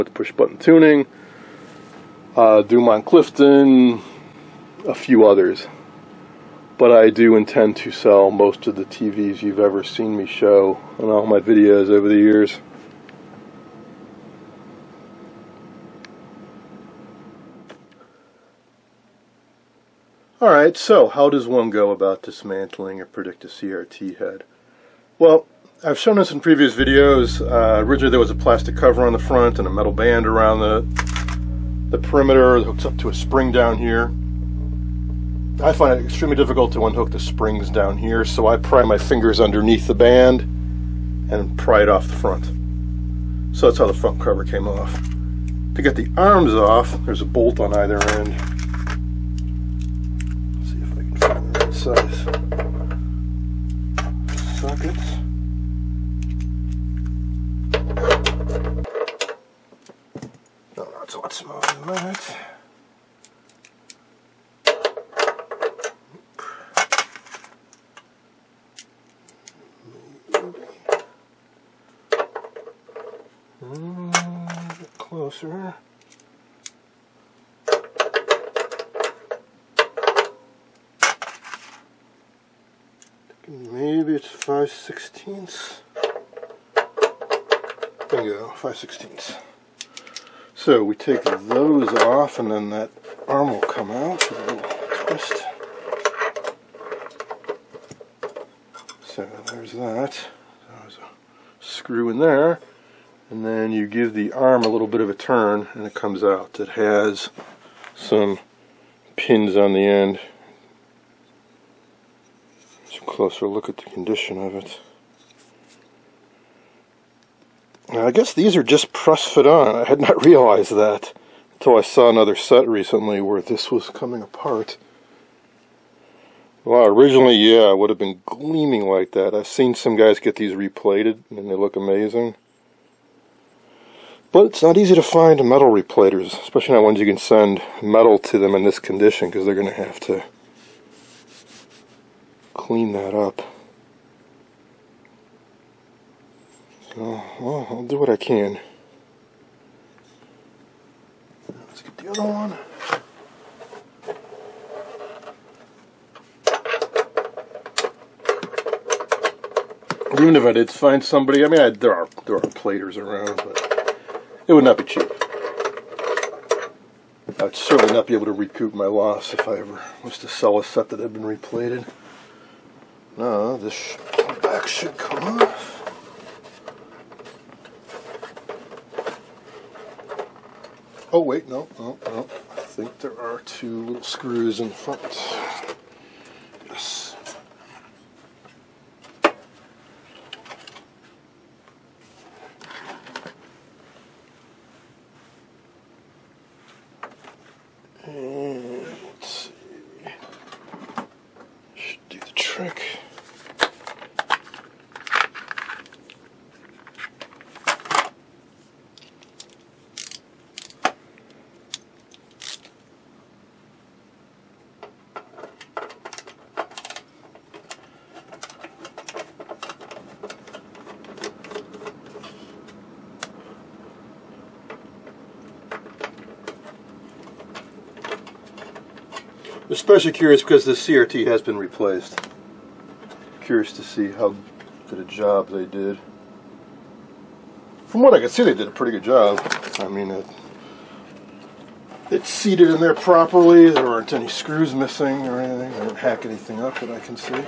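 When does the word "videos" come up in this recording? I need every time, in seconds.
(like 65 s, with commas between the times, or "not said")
11 s, 26 s.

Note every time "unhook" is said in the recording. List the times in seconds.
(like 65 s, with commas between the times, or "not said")
36 s.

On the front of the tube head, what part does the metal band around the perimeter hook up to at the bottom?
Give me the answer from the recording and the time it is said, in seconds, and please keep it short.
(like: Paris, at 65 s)
a spring, at 33 s.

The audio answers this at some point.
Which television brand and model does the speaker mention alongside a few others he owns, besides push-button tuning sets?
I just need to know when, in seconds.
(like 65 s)
2 s.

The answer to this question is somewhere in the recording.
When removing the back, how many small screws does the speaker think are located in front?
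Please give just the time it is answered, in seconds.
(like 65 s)
183 s.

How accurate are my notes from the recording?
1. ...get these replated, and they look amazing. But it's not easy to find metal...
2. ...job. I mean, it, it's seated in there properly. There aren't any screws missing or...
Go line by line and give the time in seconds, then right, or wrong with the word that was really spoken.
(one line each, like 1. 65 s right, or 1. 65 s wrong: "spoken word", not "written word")
1. 130 s right
2. 239 s right.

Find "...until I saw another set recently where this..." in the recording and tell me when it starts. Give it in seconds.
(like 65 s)
121 s.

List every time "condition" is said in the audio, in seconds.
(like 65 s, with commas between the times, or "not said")
113 s, 138 s.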